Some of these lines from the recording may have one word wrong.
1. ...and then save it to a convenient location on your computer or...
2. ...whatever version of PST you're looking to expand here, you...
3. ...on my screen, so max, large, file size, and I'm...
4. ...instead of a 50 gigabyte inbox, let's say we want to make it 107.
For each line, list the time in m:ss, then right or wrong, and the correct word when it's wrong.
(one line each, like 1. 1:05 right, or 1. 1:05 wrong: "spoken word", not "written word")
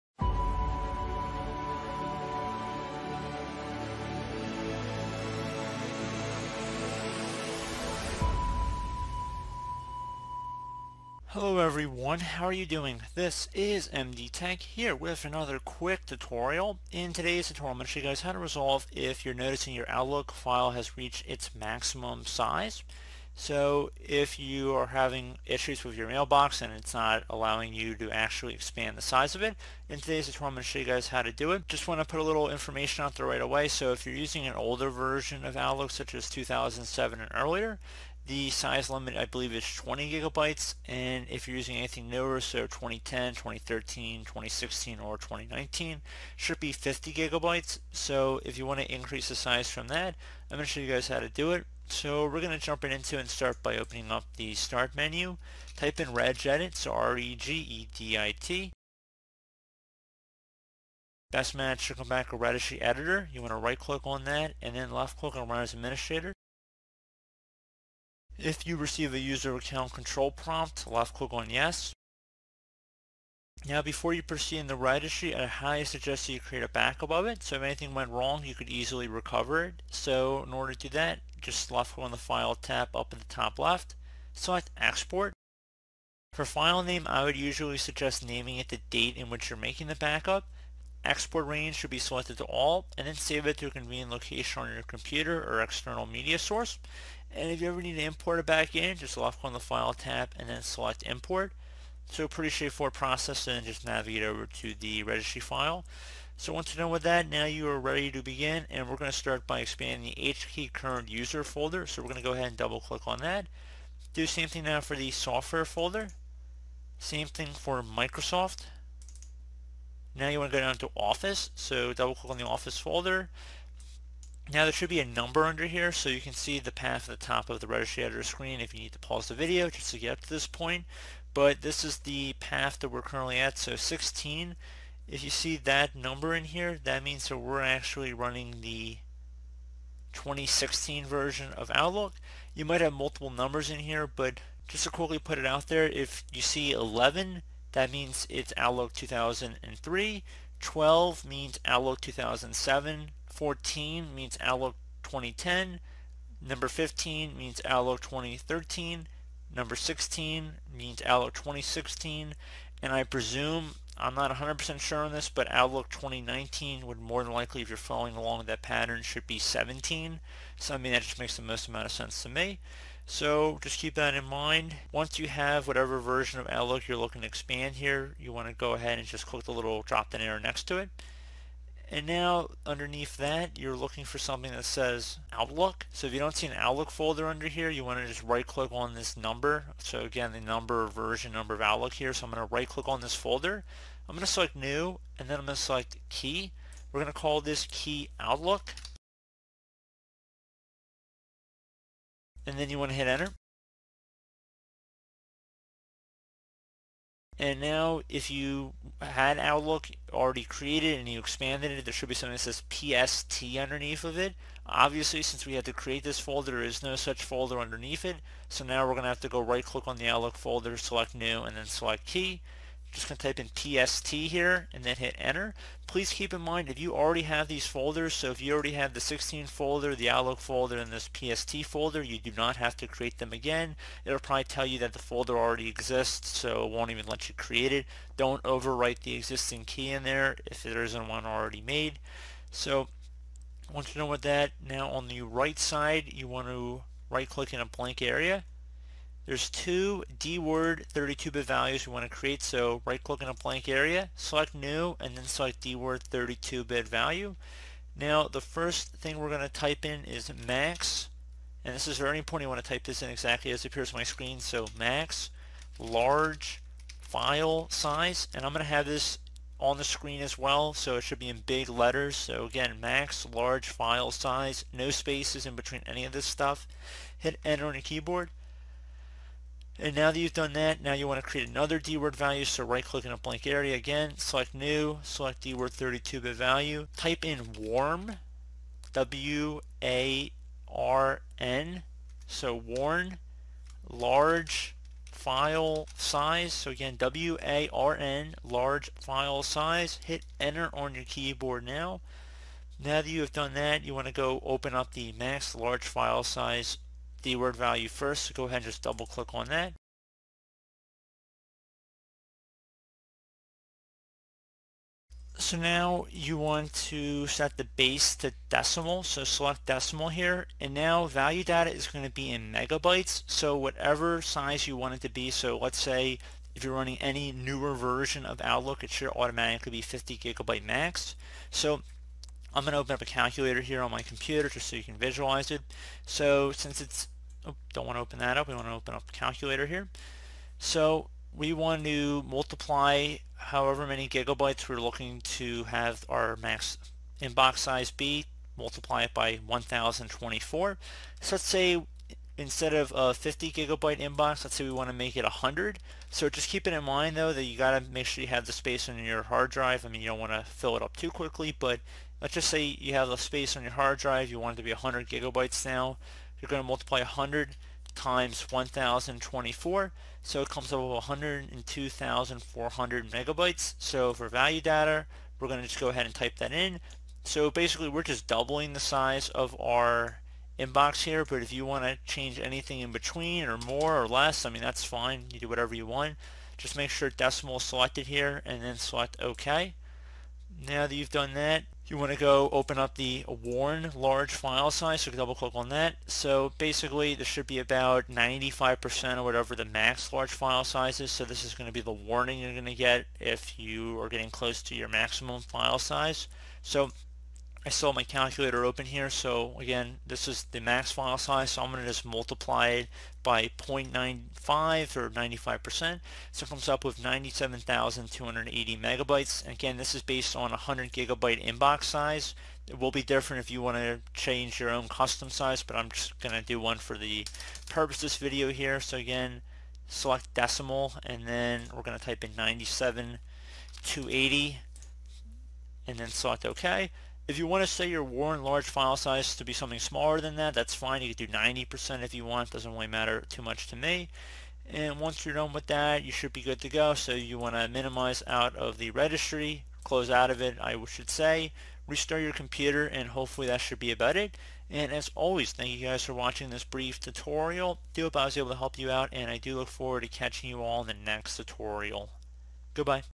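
1. 1:32 right
2. 2:55 wrong: "Outlook", not "PST"
3. 4:23 right
4. 5:52 wrong: "100", not "107".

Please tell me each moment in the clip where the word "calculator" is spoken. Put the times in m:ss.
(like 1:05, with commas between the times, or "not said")
5:33, 5:39, 6:48.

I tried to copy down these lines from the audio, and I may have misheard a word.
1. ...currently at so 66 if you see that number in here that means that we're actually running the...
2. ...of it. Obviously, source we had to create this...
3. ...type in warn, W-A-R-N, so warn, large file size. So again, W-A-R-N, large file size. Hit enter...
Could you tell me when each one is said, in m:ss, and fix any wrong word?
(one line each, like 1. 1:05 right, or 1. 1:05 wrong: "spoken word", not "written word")
1. 2:13 wrong: "16", not "66"
2. 3:34 wrong: "since", not "source"
3. 4:46 right.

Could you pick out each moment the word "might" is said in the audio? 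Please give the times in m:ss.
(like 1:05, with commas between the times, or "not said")
2:22.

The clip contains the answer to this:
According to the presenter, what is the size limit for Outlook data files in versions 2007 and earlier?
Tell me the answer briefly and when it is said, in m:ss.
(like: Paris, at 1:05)
20 gigabytes, at 0:39.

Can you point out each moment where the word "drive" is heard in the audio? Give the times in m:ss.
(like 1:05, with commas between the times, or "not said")
5:59, 6:03.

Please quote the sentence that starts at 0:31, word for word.
Just want to put a little information out there right away.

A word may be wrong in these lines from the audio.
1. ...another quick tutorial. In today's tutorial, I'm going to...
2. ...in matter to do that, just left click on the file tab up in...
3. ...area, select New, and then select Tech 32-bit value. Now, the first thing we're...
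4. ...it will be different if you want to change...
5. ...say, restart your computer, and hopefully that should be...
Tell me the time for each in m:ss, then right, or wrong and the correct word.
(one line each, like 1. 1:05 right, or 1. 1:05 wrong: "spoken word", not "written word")
1. 0:15 right
2. 1:20 wrong: "order", not "matter"
3. 4:13 wrong: "DWORD", not "Tech"
4. 7:02 right
5. 7:31 right.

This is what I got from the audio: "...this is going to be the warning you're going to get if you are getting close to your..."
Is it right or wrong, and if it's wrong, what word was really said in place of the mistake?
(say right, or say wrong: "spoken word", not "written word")
right.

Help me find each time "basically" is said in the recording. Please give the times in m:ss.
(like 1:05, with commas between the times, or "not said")
6:17, 6:36.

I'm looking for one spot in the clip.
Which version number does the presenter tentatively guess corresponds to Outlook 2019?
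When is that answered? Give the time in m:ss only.
2:49.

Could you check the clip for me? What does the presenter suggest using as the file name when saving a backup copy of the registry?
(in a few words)
the date.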